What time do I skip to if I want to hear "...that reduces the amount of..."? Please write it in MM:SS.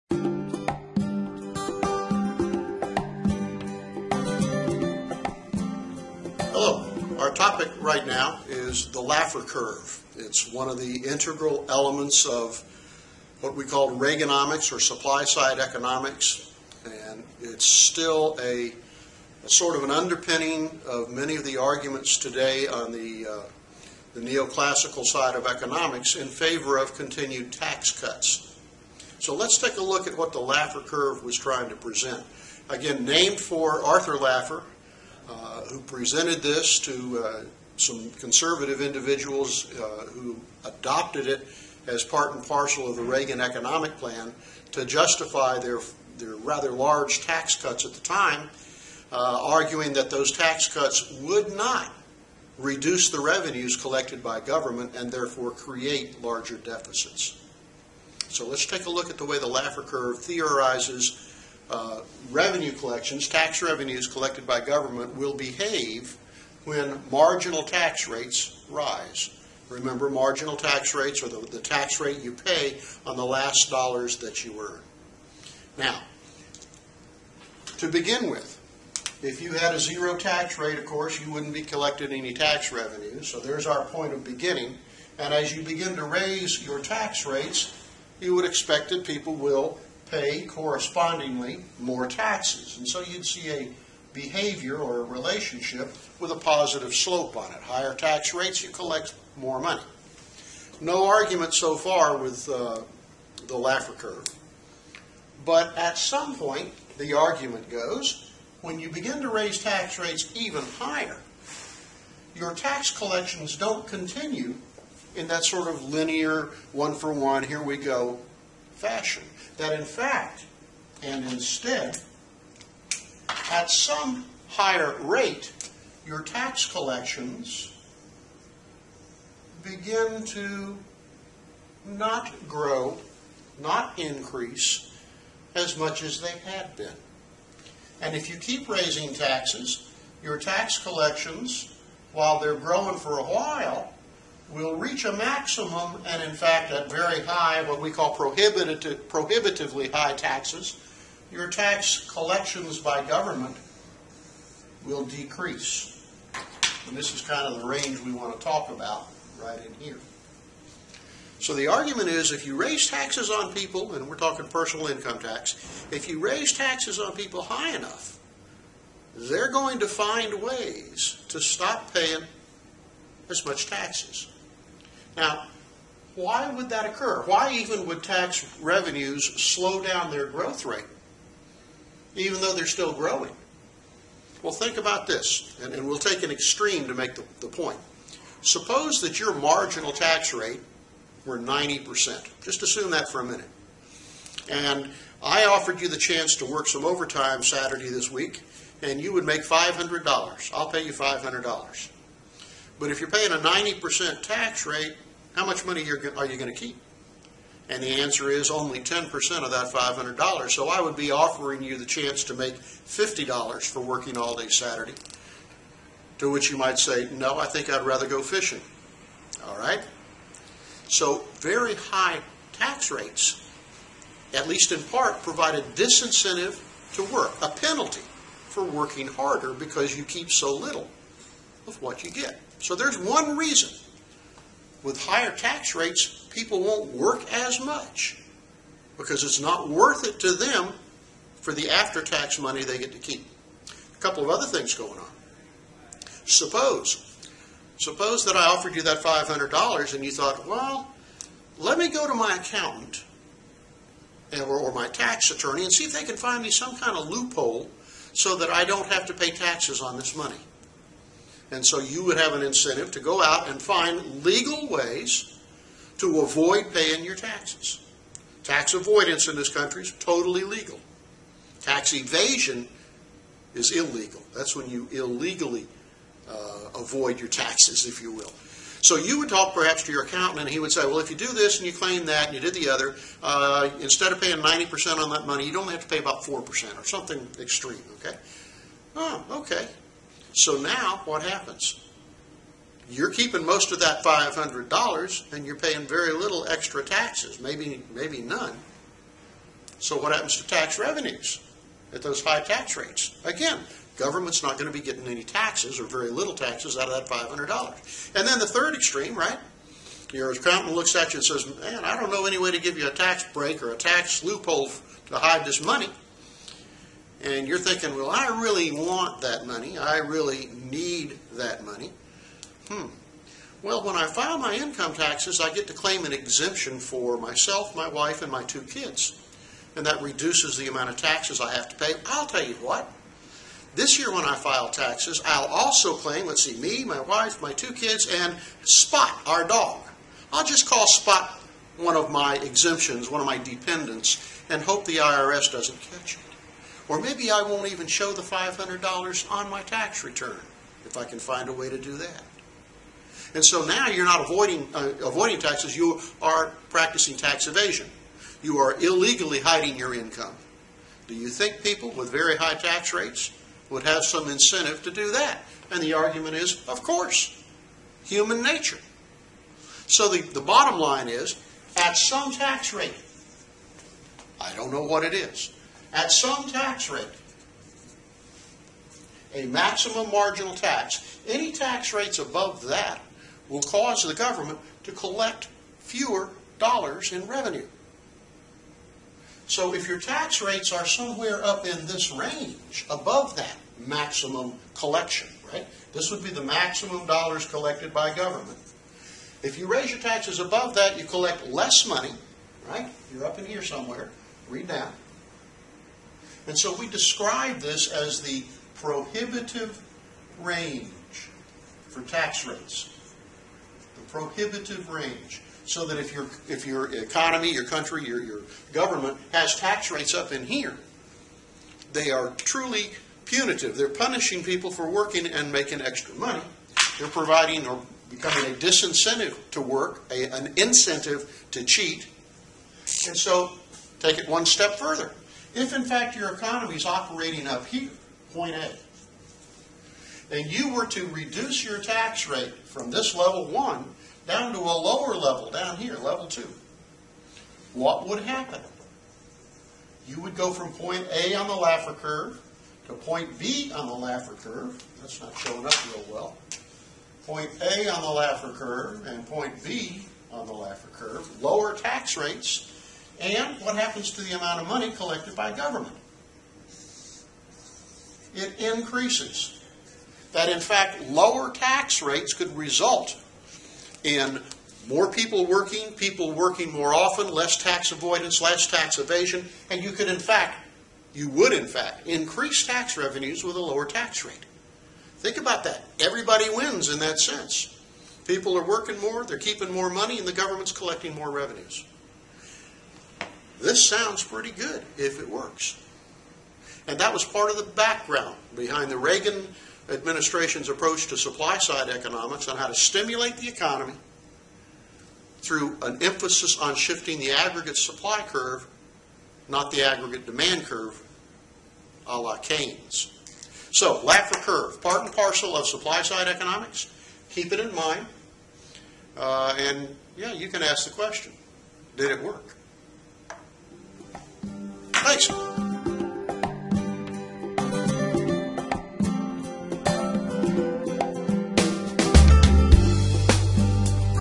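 05:29.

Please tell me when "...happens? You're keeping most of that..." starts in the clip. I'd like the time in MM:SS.
04:51.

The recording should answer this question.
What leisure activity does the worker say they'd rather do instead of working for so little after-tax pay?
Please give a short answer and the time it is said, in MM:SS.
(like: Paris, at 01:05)
Go fishing, at 03:38.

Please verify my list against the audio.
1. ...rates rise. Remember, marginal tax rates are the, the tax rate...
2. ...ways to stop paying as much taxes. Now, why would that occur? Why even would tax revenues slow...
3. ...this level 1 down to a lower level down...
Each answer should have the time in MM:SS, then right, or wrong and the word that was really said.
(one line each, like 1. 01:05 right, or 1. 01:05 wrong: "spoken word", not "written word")
1. 01:08 right
2. 02:50 right
3. 07:22 right.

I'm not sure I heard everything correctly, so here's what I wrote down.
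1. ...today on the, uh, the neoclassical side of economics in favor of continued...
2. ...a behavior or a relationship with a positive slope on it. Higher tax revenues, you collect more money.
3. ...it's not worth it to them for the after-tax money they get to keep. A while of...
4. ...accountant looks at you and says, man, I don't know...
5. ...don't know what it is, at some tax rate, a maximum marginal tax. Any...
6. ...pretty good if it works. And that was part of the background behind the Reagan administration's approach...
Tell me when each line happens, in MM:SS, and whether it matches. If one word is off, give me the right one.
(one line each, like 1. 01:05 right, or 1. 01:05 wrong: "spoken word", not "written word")
1. 00:22 right
2. 01:33 wrong: "rates", not "revenues"
3. 03:59 wrong: "couple", not "while"
4. 05:10 right
5. 06:14 right
6. 08:14 right.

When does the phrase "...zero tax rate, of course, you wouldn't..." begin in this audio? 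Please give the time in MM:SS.
01:19.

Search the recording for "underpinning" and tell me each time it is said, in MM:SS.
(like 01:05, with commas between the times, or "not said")
00:19.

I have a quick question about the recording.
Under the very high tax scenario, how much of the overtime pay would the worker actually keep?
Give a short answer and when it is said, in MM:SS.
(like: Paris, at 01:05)
$50, at 03:32.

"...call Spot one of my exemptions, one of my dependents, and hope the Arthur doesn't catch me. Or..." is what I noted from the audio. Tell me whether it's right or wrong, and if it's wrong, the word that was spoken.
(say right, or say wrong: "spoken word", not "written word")
wrong: "IRS", not "Arthur".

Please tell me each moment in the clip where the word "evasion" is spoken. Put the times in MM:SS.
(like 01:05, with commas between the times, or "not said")
04:31, 05:57, 07:58.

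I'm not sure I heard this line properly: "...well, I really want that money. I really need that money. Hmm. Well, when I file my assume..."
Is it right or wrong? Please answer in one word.
wrong.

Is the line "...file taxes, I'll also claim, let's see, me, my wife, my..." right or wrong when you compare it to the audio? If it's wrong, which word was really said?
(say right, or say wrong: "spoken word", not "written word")
right.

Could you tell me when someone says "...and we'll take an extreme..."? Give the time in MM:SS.
03:05.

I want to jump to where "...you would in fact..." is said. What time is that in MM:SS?
08:01.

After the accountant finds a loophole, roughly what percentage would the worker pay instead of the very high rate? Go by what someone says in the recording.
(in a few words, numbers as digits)
4%.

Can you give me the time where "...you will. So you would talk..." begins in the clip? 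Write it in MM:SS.
04:38.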